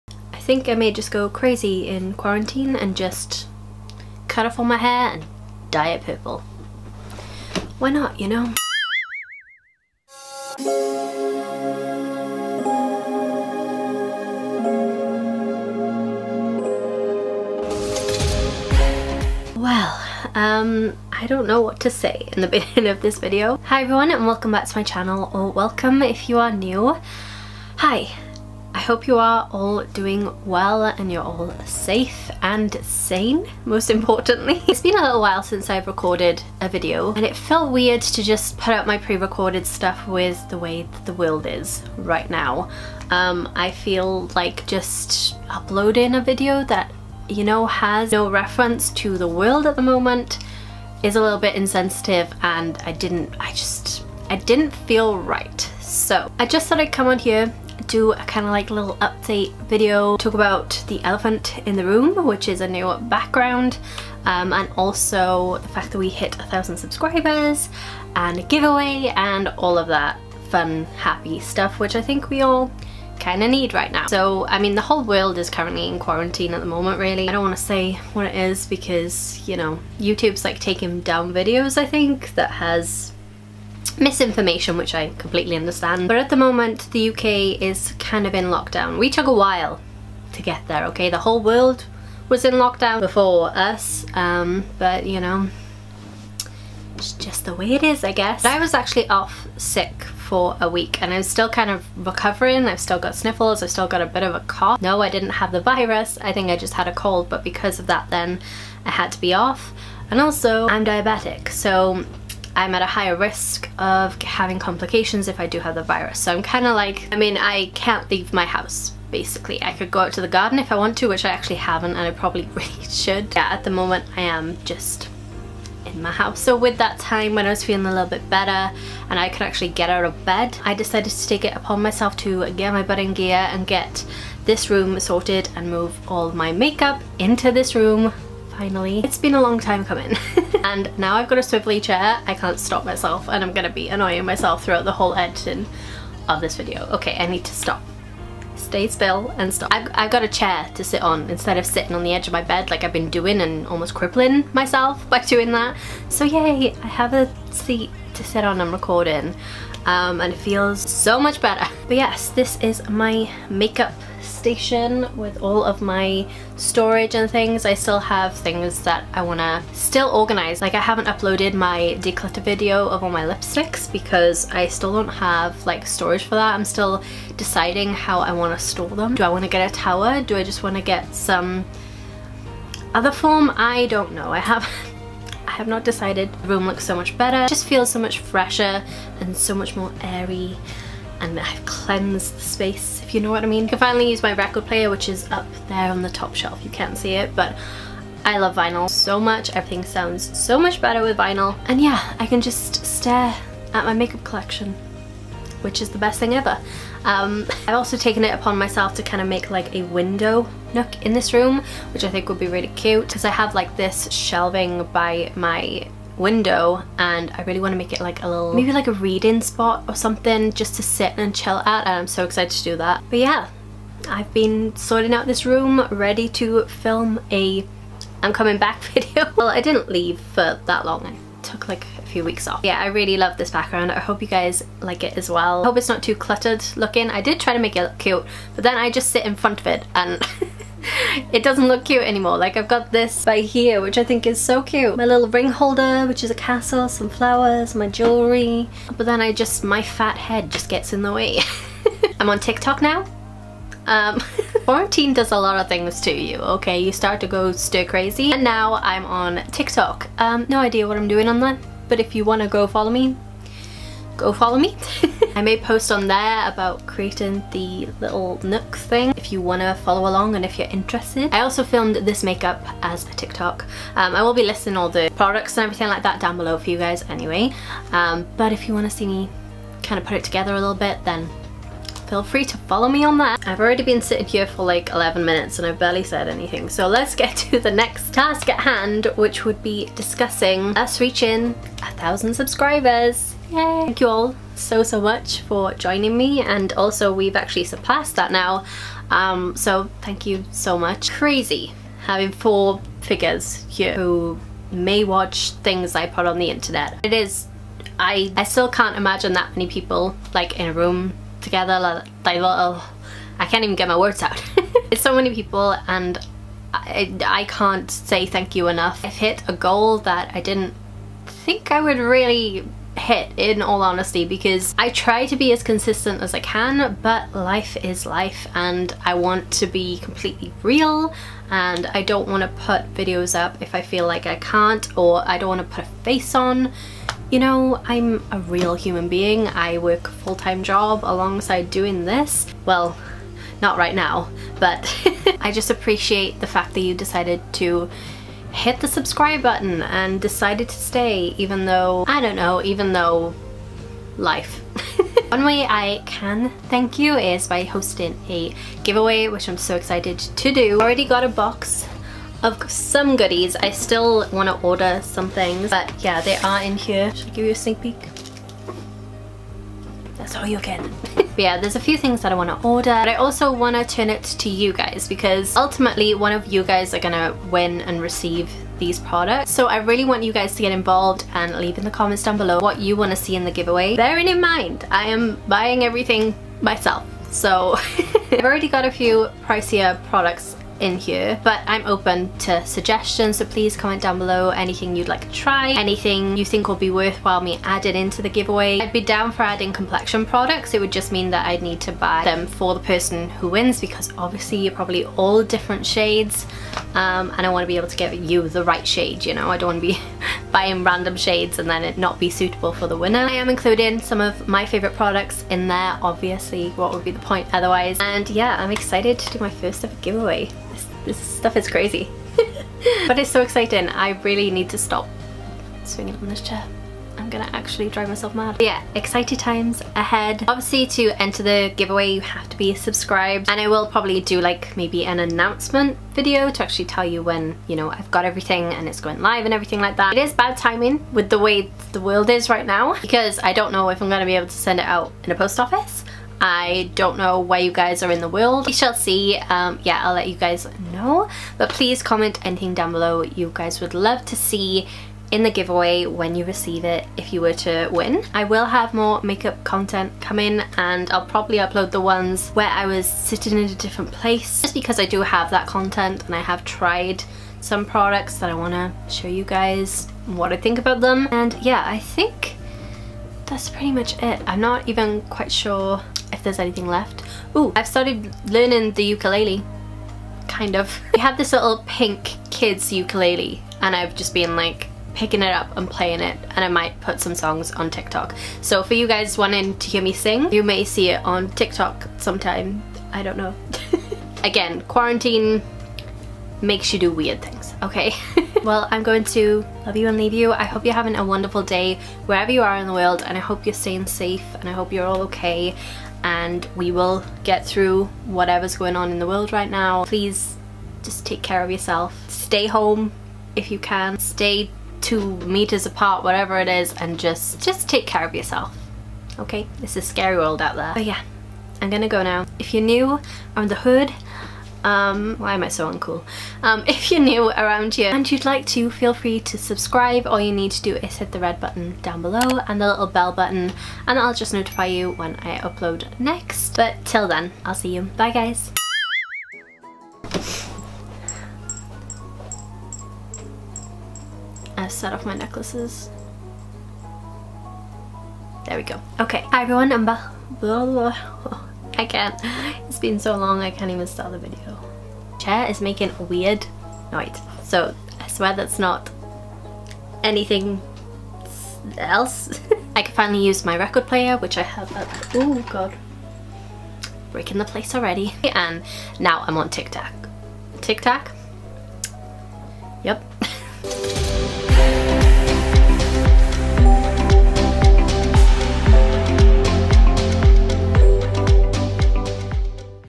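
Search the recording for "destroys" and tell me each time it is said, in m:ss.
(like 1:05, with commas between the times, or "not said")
not said.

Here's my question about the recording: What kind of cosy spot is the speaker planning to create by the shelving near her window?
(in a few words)
A reading spot.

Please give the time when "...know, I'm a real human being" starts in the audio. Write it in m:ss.
5:37.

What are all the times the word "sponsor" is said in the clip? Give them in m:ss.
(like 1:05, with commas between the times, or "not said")
not said.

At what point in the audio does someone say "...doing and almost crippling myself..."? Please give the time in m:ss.
2:33.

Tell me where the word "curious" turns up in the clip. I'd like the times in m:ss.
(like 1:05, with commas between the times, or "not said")
not said.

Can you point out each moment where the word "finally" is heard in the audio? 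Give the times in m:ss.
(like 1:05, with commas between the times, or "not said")
2:18, 3:13, 9:23.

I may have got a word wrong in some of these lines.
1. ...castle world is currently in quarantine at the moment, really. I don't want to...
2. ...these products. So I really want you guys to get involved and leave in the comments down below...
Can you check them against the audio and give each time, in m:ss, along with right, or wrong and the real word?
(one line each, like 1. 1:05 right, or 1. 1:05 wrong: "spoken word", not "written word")
1. 1:14 wrong: "whole", not "castle"
2. 6:18 right.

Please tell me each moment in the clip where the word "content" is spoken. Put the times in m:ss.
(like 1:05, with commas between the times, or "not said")
7:39, 7:45.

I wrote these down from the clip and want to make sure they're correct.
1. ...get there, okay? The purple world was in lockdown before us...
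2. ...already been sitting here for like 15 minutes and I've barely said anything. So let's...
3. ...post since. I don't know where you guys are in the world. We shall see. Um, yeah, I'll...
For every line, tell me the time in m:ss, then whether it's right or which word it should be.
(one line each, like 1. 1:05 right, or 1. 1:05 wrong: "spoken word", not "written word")
1. 1:30 wrong: "whole", not "purple"
2. 4:43 wrong: "11", not "15"
3. 7:25 wrong: "office", not "since".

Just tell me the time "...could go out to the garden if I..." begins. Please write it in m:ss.
1:59.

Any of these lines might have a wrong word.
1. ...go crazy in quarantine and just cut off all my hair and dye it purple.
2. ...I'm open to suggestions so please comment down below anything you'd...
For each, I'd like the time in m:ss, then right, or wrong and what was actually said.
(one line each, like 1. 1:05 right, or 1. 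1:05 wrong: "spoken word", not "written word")
1. 0:01 right
2. 6:31 right.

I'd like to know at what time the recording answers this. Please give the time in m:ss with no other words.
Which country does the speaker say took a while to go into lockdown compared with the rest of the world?
1:26.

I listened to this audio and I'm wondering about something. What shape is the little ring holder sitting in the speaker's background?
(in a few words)
A castle.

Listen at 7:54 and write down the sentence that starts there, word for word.
I'm not even quite sure if there's anything left.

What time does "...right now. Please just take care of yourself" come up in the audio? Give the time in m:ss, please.
8:29.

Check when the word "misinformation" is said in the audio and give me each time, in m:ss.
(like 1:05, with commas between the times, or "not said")
1:23.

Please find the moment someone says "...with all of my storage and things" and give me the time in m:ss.
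2:45.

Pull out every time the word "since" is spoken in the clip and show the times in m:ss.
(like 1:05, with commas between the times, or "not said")
0:35.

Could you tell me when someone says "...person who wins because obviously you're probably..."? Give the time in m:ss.
6:42.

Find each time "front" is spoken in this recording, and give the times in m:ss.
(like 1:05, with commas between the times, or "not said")
3:59.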